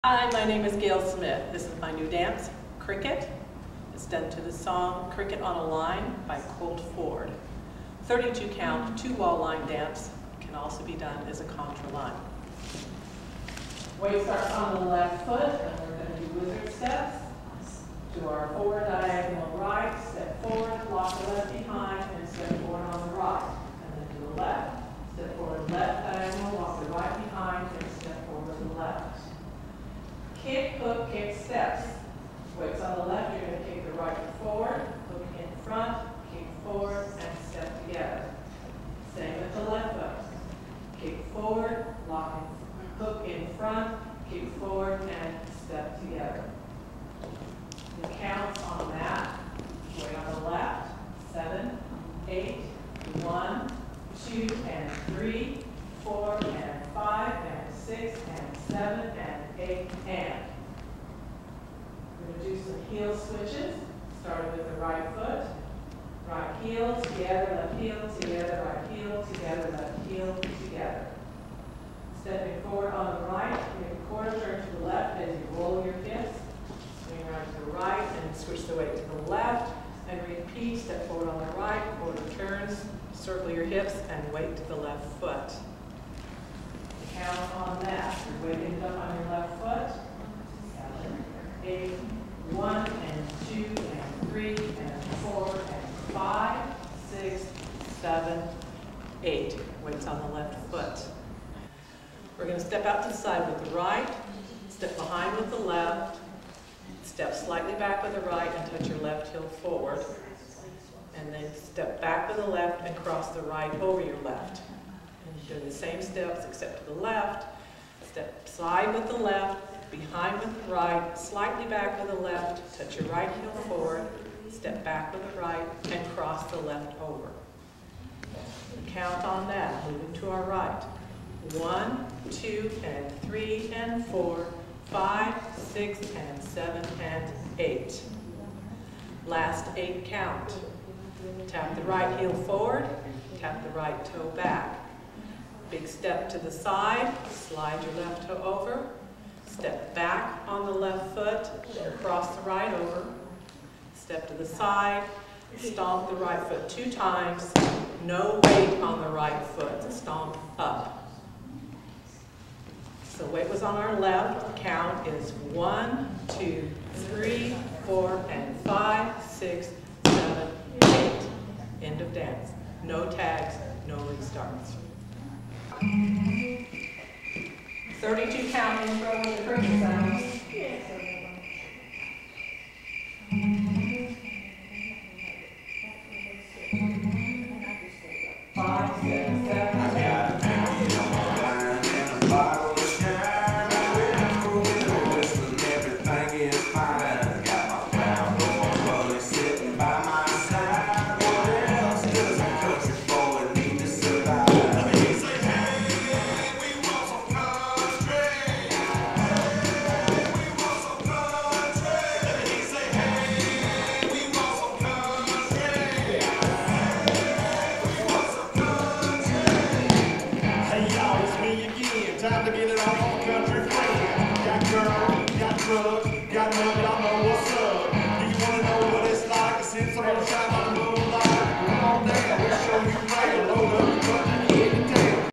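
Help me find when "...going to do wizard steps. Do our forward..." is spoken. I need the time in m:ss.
0:16.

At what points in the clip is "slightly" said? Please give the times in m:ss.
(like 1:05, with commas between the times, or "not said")
1:47, 2:01.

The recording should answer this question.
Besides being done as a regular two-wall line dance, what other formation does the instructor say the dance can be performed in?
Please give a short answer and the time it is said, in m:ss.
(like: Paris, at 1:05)
contra line, at 0:11.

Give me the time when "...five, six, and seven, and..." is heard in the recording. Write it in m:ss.
2:14.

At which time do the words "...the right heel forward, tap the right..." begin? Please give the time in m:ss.
2:21.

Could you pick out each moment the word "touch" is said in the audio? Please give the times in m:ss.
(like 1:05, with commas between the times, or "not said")
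1:48, 2:02.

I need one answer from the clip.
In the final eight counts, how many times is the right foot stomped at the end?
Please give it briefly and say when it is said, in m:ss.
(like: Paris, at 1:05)
2, at 2:36.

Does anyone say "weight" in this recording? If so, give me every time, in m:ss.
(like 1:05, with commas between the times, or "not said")
0:14, 0:32, 0:49, 1:18, 1:24, 1:39, 2:38, 2:43.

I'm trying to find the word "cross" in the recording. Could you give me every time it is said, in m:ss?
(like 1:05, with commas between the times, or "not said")
1:52, 2:06, 2:32.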